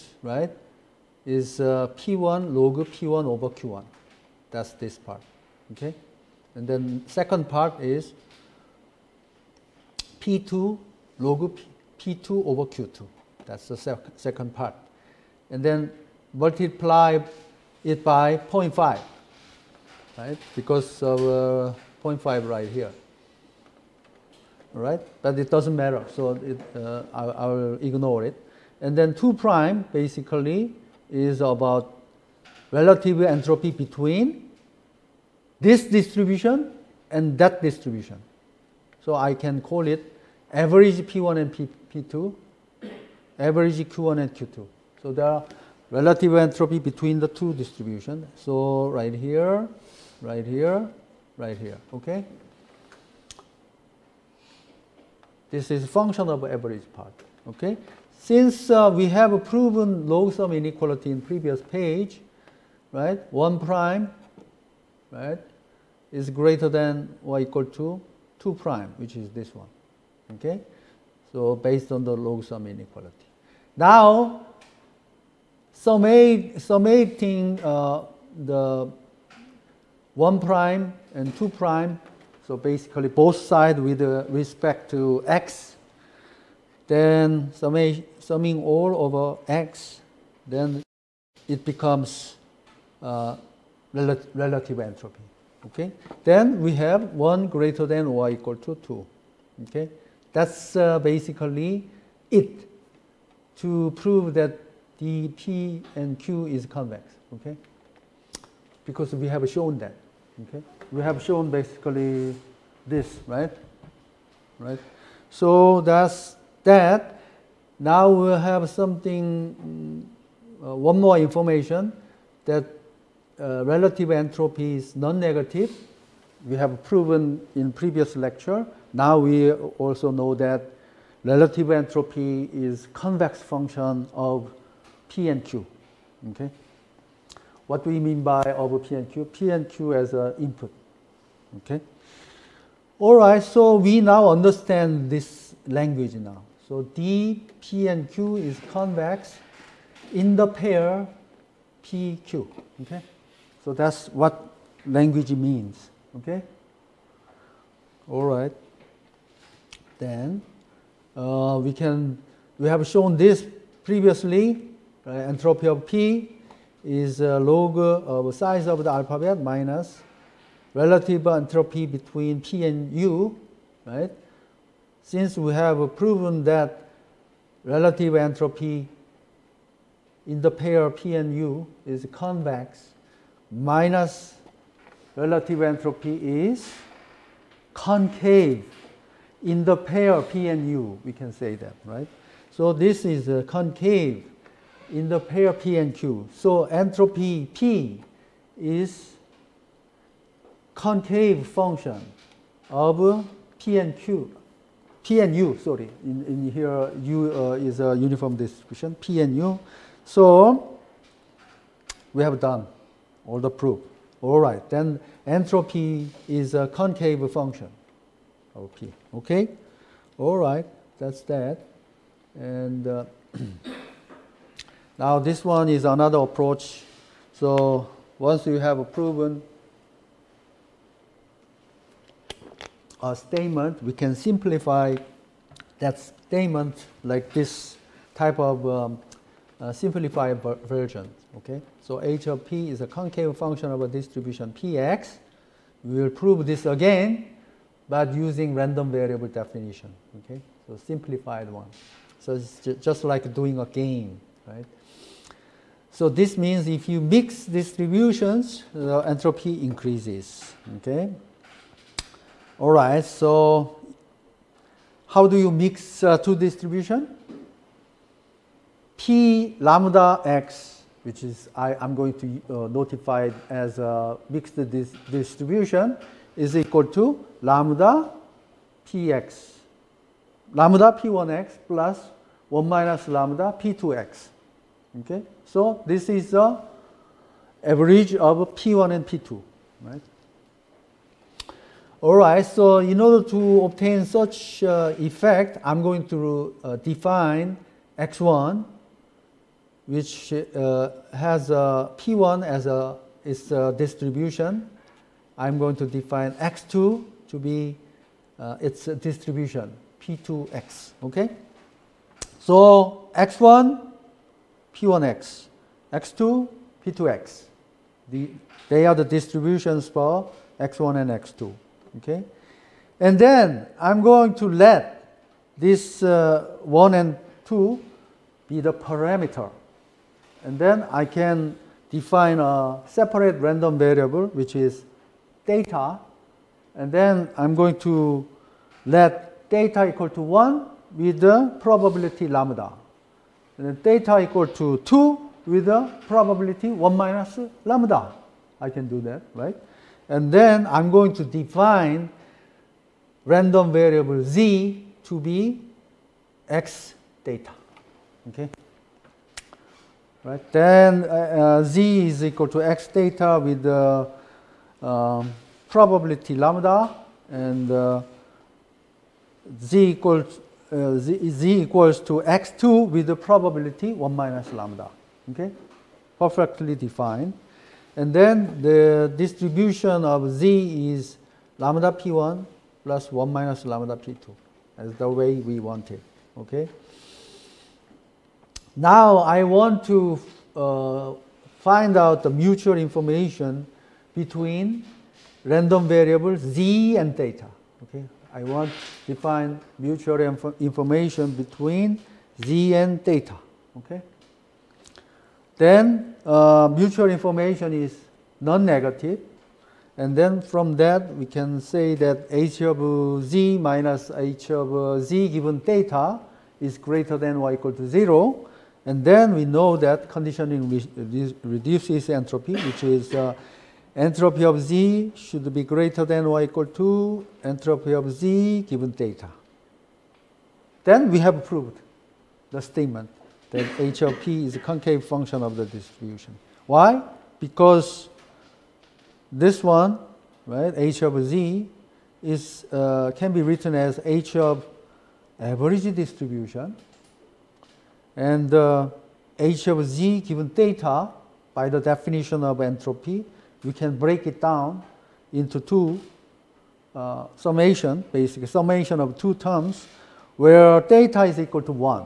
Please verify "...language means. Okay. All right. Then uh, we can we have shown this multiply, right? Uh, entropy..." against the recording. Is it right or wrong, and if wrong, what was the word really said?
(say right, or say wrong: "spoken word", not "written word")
wrong: "previously", not "multiply".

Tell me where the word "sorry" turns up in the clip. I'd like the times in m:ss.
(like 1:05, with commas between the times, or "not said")
3:25.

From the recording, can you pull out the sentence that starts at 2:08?
Now we also know that relative entropy is convex function of P and Q.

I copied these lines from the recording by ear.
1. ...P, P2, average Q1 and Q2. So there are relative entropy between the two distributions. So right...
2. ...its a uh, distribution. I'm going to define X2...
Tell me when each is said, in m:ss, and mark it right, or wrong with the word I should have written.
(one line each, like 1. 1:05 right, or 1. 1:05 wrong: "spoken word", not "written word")
1. 0:41 right
2. 5:03 right.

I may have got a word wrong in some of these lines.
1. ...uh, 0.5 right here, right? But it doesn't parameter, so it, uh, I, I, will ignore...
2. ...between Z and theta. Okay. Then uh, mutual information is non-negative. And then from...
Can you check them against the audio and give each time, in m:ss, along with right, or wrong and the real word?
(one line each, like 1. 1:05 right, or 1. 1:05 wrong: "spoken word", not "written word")
1. 0:21 wrong: "matter", not "parameter"
2. 6:41 right.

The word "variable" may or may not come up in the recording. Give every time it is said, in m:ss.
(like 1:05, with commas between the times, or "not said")
4:08, 5:33, 5:53, 6:35.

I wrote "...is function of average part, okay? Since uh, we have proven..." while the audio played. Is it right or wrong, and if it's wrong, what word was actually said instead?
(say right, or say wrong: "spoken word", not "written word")
right.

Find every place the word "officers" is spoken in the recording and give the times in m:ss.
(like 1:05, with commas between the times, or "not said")
not said.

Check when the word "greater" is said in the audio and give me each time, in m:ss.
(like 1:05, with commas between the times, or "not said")
1:06, 1:37, 6:56, 7:05.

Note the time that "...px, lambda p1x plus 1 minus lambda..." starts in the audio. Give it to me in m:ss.
4:38.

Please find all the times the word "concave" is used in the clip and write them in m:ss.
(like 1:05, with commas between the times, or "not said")
3:07, 3:13, 3:20, 3:36, 4:02, 7:14.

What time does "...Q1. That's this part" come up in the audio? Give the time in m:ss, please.
0:03.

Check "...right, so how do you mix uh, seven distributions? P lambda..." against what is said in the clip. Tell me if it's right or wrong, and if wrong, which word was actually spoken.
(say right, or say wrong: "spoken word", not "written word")
wrong: "two", not "seven".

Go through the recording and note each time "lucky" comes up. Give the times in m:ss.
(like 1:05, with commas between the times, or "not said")
not said.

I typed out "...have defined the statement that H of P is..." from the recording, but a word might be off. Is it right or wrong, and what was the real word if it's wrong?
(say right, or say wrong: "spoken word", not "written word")
wrong: "proved", not "defined".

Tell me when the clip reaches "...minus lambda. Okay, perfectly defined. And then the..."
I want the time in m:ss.
6:14.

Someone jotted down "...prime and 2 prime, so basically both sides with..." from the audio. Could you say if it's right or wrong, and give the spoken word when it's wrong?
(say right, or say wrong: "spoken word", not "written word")
right.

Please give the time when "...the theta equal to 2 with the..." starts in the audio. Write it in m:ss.
5:43.